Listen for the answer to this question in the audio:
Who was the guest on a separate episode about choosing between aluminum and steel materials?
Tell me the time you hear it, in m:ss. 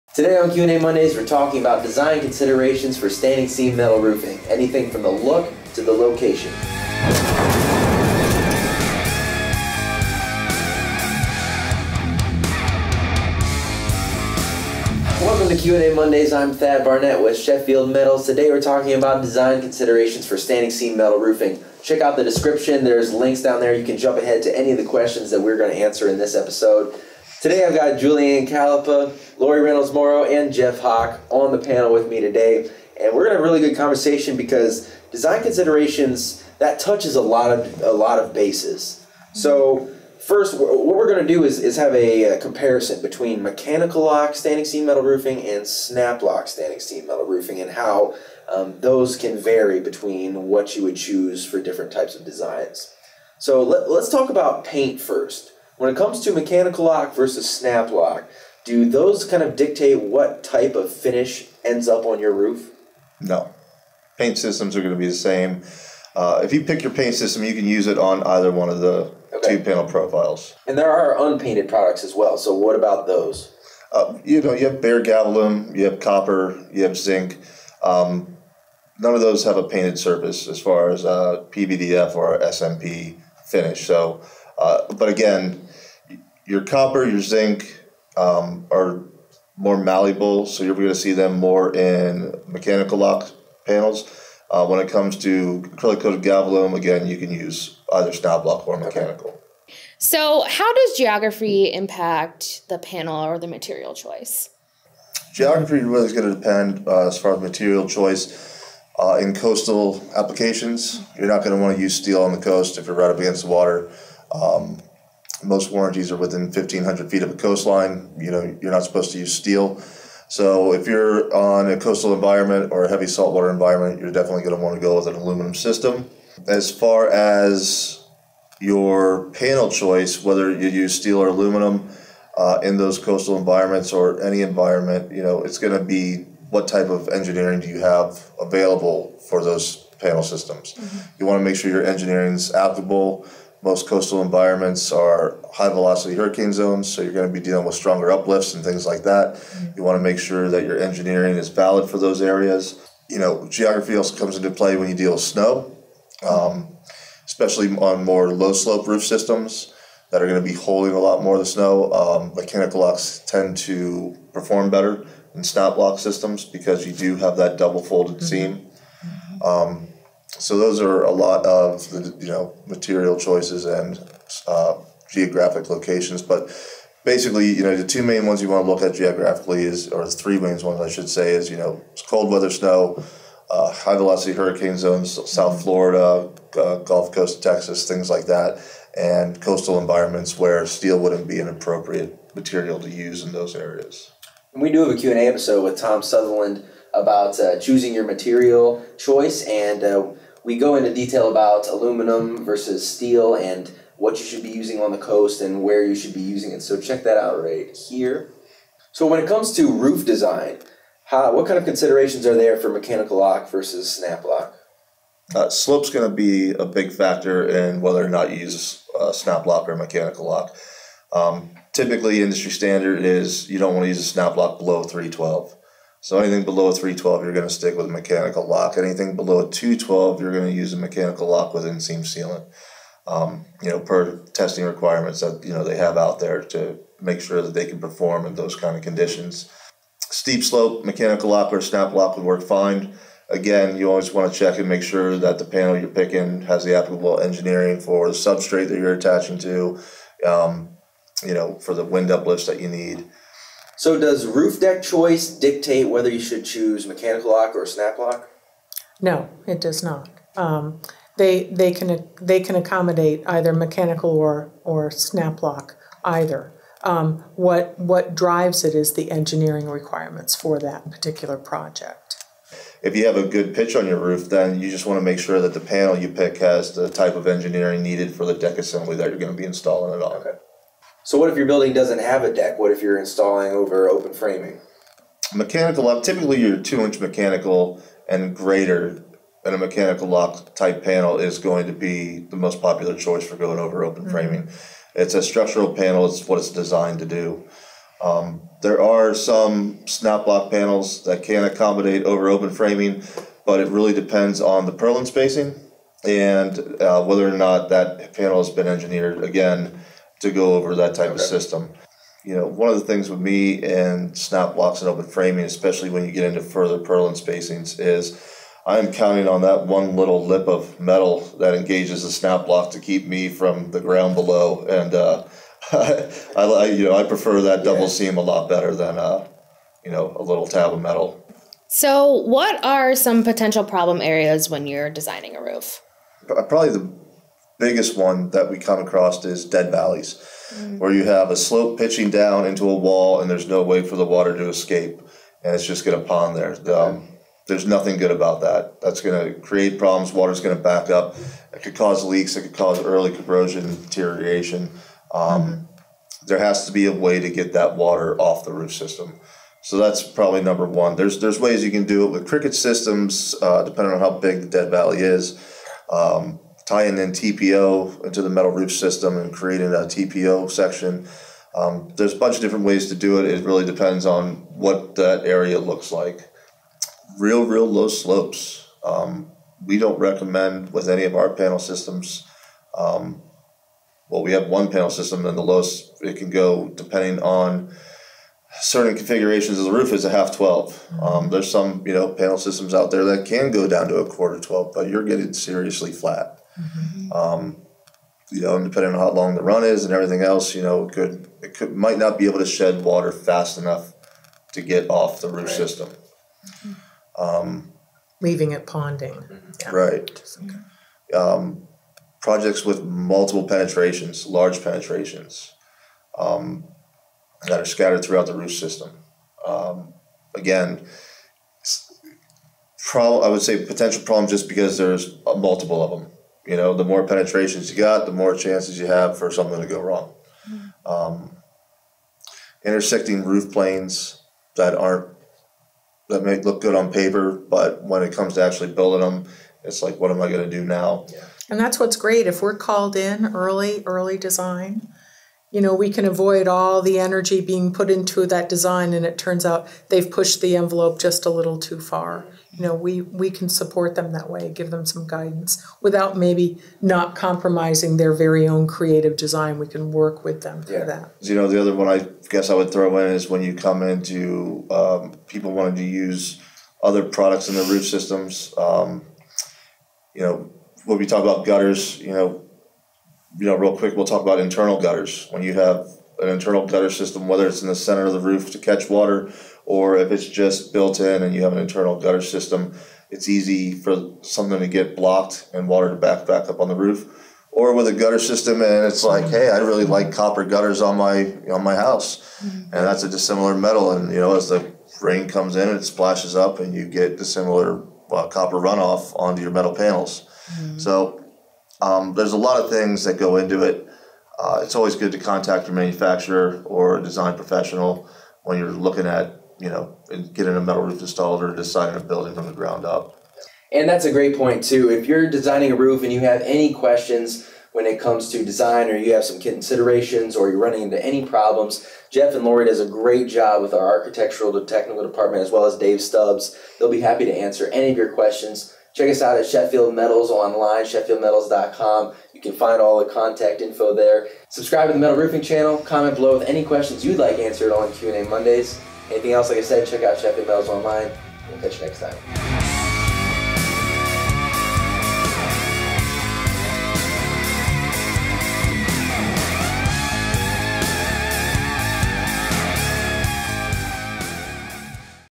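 3:15.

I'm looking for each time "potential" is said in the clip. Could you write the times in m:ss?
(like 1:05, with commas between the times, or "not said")
5:33, 7:03.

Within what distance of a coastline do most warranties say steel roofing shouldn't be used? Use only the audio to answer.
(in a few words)
1,500 feet.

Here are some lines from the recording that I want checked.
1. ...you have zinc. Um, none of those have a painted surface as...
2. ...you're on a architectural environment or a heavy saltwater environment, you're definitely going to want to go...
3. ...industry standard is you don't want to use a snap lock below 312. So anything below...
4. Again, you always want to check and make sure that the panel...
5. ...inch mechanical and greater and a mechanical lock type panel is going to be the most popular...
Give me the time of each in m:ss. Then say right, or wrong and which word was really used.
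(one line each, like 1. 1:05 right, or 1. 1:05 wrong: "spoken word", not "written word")
1. 1:16 right
2. 2:00 wrong: "coastal", not "architectural"
3. 3:42 right
4. 4:03 right
5. 4:46 right.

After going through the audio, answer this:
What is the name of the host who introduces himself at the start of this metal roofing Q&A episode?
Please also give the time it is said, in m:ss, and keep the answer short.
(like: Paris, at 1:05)
Thad Barnette, at 0:16.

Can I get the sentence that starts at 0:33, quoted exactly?
And we're gonna have a really good conversation because design considerations that touches a lot of a lot of bases.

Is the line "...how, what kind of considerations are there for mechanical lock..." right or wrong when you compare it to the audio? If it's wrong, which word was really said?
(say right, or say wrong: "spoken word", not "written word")
right.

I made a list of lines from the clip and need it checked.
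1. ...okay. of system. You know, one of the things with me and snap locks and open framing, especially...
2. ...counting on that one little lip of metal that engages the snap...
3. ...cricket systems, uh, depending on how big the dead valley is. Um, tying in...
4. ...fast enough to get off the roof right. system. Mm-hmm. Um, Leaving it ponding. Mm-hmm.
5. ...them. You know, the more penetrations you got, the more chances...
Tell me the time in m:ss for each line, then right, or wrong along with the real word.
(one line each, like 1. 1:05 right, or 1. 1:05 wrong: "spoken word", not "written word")
1. 5:11 right
2. 5:18 right
3. 6:02 right
4. 6:43 right
5. 7:05 right.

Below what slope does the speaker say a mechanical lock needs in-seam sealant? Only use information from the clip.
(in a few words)
2:12.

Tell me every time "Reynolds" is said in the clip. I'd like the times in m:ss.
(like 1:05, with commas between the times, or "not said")
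0:29.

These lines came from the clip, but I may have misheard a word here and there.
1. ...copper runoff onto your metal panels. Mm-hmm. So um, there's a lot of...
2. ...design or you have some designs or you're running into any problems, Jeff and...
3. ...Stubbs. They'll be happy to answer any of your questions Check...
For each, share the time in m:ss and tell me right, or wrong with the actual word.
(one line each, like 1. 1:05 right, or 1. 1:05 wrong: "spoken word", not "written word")
1. 8:18 right
2. 8:38 wrong: "considerations", not "designs"
3. 8:46 right.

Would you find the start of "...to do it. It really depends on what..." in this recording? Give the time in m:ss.
6:12.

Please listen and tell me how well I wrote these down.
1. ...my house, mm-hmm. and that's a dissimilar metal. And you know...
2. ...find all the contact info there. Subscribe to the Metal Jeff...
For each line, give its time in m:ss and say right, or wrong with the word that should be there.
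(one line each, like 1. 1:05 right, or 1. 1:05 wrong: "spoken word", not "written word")
1. 8:11 right
2. 8:52 wrong: "Roofing", not "Jeff".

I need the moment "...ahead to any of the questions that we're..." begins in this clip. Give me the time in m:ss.
0:24.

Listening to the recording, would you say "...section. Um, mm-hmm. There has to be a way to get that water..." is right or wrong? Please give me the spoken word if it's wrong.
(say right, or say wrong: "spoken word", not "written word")
wrong: "deterioration", not "section".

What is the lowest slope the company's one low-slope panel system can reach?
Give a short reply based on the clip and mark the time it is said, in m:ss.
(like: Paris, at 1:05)
1/2:12, at 6:30.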